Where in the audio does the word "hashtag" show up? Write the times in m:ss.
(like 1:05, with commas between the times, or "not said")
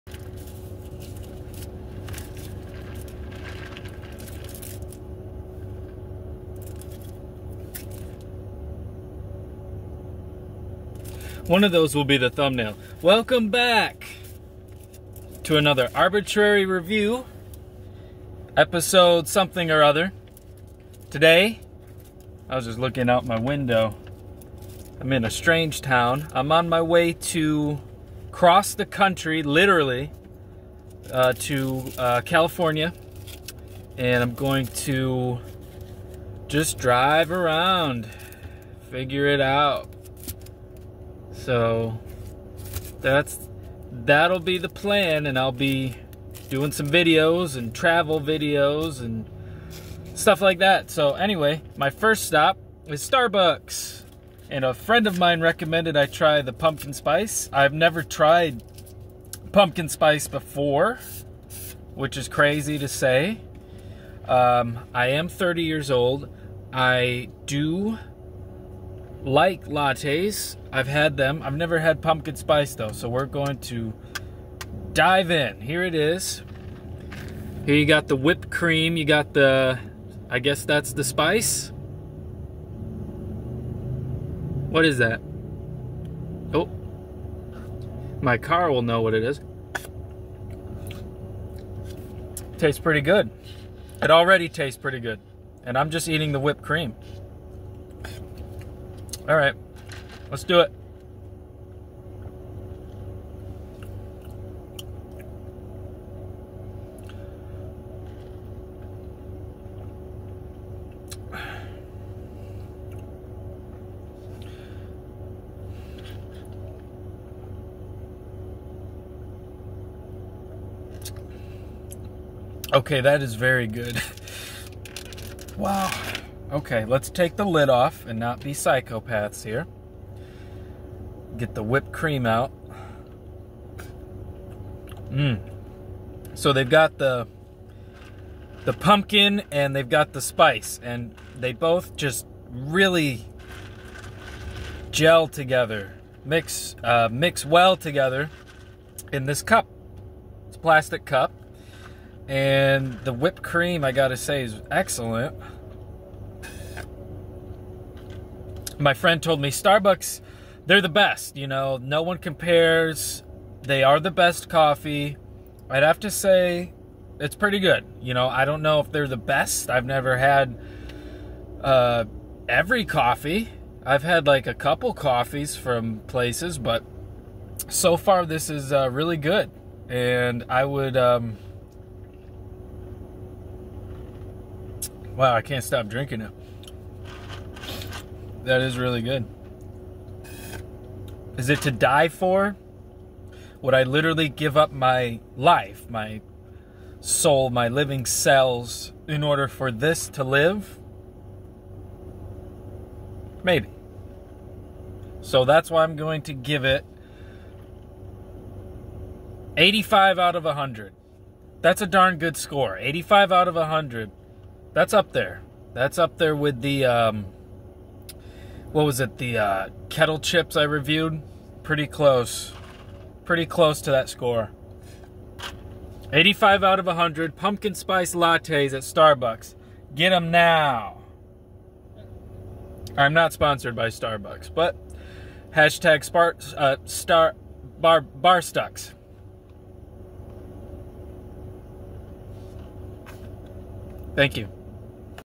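3:55.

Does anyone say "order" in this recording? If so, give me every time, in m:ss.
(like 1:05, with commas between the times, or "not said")
3:19.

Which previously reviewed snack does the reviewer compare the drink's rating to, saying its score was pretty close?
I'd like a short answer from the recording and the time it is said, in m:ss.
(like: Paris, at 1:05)
kettle chips, at 3:39.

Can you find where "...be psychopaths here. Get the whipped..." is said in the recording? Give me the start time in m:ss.
2:08.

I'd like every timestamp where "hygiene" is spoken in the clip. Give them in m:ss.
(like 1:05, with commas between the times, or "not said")
not said.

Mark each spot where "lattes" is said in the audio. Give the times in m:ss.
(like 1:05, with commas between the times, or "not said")
1:09, 3:48.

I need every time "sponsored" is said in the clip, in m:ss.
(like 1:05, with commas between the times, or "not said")
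3:53.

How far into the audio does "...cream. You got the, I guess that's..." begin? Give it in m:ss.
1:18.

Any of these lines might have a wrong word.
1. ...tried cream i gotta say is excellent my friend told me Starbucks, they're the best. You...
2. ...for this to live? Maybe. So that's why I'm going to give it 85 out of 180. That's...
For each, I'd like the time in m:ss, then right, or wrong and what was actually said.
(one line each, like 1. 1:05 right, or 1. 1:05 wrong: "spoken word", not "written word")
1. 2:33 wrong: "whipped", not "tried"
2. 3:19 wrong: "100", not "180".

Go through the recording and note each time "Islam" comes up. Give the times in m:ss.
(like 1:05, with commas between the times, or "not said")
not said.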